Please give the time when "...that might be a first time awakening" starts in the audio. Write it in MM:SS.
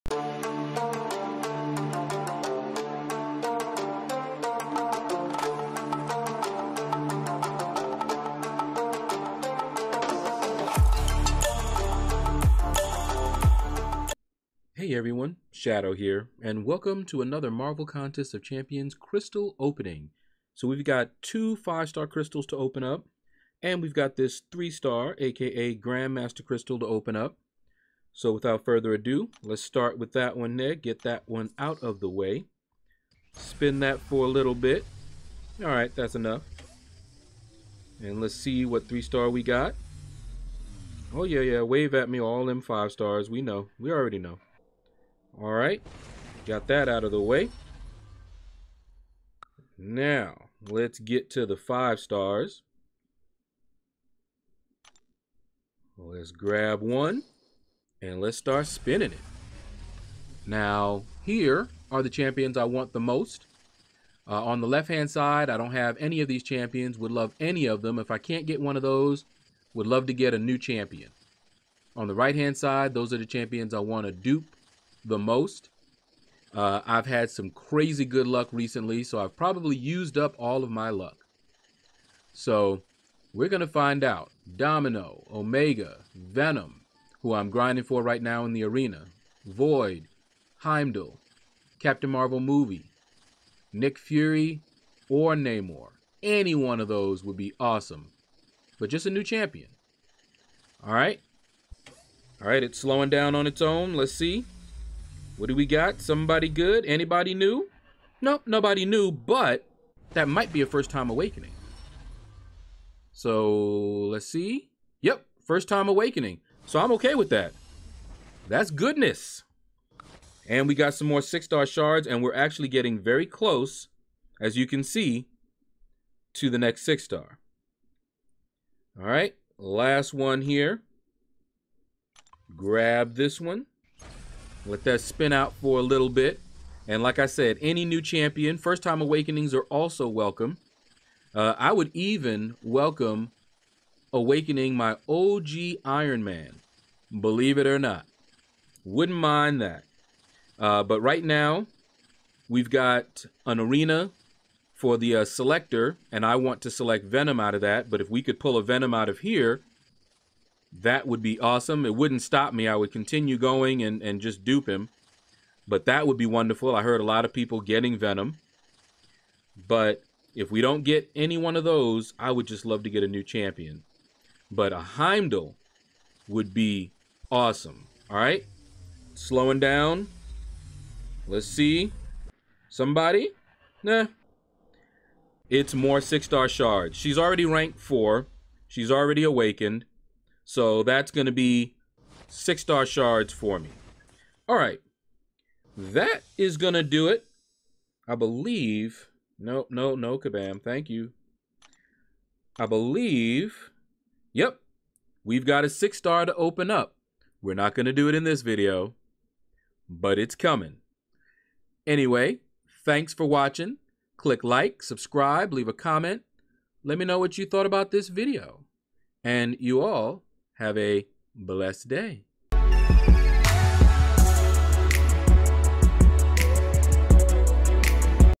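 01:50.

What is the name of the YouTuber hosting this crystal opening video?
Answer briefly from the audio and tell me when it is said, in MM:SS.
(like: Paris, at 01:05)
Shaedow, at 00:15.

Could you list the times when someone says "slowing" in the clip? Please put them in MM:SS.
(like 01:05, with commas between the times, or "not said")
01:42, 02:59.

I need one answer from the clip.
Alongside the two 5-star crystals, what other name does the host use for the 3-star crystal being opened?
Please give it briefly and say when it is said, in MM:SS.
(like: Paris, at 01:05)
Grandmaster Crystal, at 00:25.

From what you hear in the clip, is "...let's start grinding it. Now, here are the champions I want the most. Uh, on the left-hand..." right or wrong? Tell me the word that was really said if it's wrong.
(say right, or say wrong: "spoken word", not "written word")
wrong: "spinning", not "grinding".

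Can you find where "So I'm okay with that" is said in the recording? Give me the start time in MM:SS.
01:56.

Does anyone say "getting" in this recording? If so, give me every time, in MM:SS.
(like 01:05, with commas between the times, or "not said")
02:02, 02:47.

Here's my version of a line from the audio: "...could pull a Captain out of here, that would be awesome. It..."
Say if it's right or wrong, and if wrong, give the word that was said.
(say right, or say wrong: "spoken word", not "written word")
wrong: "Venom", not "Captain".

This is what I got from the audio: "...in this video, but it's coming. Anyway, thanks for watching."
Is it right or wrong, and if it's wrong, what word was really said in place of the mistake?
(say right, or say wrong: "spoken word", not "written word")
right.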